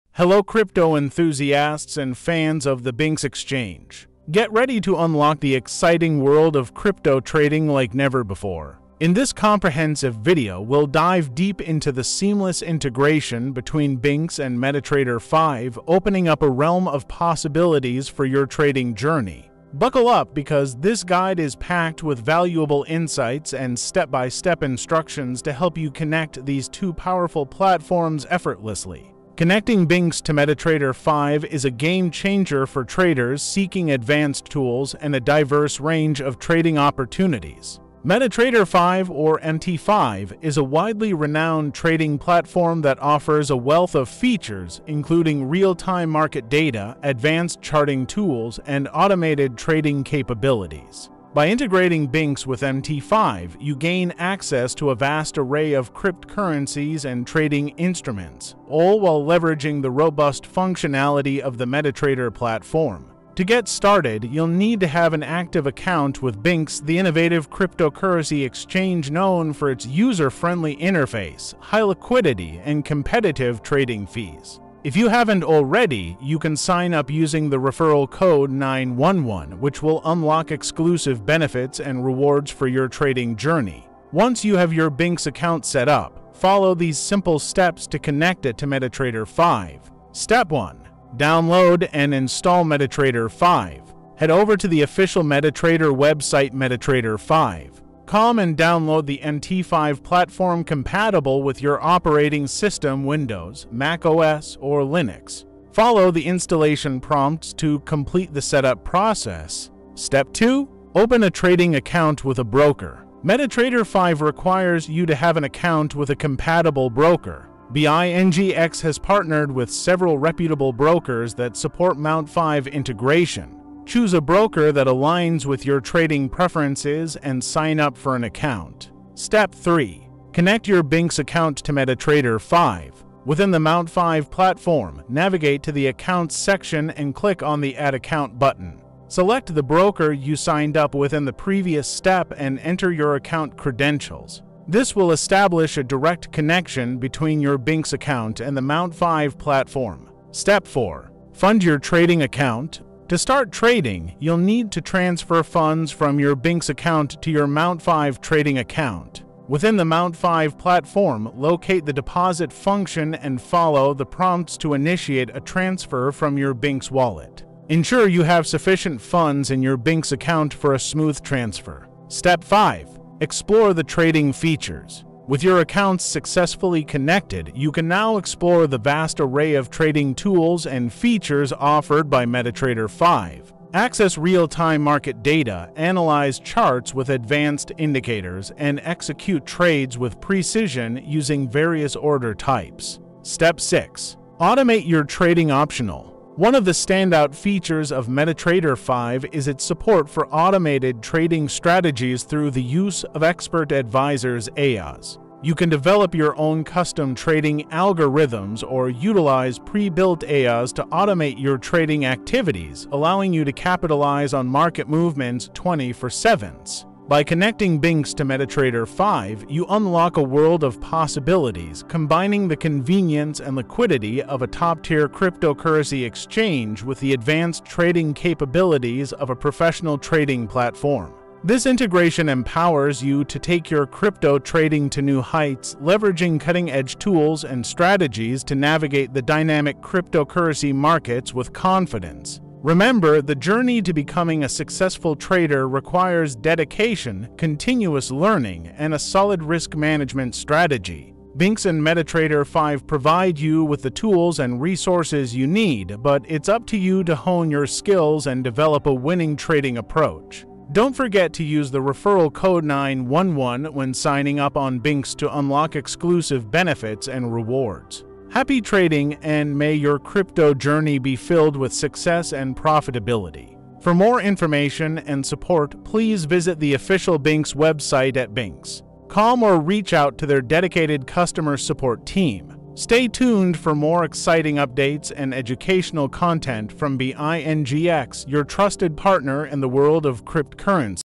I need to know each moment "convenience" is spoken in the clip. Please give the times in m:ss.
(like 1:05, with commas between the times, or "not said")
3:42.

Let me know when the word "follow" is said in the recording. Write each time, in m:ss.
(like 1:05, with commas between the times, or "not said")
1:26, 1:45, 2:43.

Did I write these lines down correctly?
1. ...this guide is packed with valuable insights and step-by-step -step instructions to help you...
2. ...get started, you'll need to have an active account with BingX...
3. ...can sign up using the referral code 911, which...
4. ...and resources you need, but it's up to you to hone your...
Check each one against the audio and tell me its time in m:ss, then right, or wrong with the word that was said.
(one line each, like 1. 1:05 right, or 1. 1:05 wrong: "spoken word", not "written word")
1. 0:20 right
2. 1:03 right
3. 1:16 right
4. 4:14 right.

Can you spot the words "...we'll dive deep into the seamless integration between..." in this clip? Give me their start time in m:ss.
0:10.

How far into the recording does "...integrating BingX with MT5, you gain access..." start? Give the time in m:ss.
0:51.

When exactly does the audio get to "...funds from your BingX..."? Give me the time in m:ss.
2:35.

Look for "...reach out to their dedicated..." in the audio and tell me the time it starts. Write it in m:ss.
4:39.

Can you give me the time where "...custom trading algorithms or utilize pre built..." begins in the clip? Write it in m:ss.
3:26.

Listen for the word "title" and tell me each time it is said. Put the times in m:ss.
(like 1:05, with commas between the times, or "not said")
not said.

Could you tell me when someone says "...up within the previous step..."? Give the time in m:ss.
2:20.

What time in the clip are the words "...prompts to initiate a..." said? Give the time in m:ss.
2:44.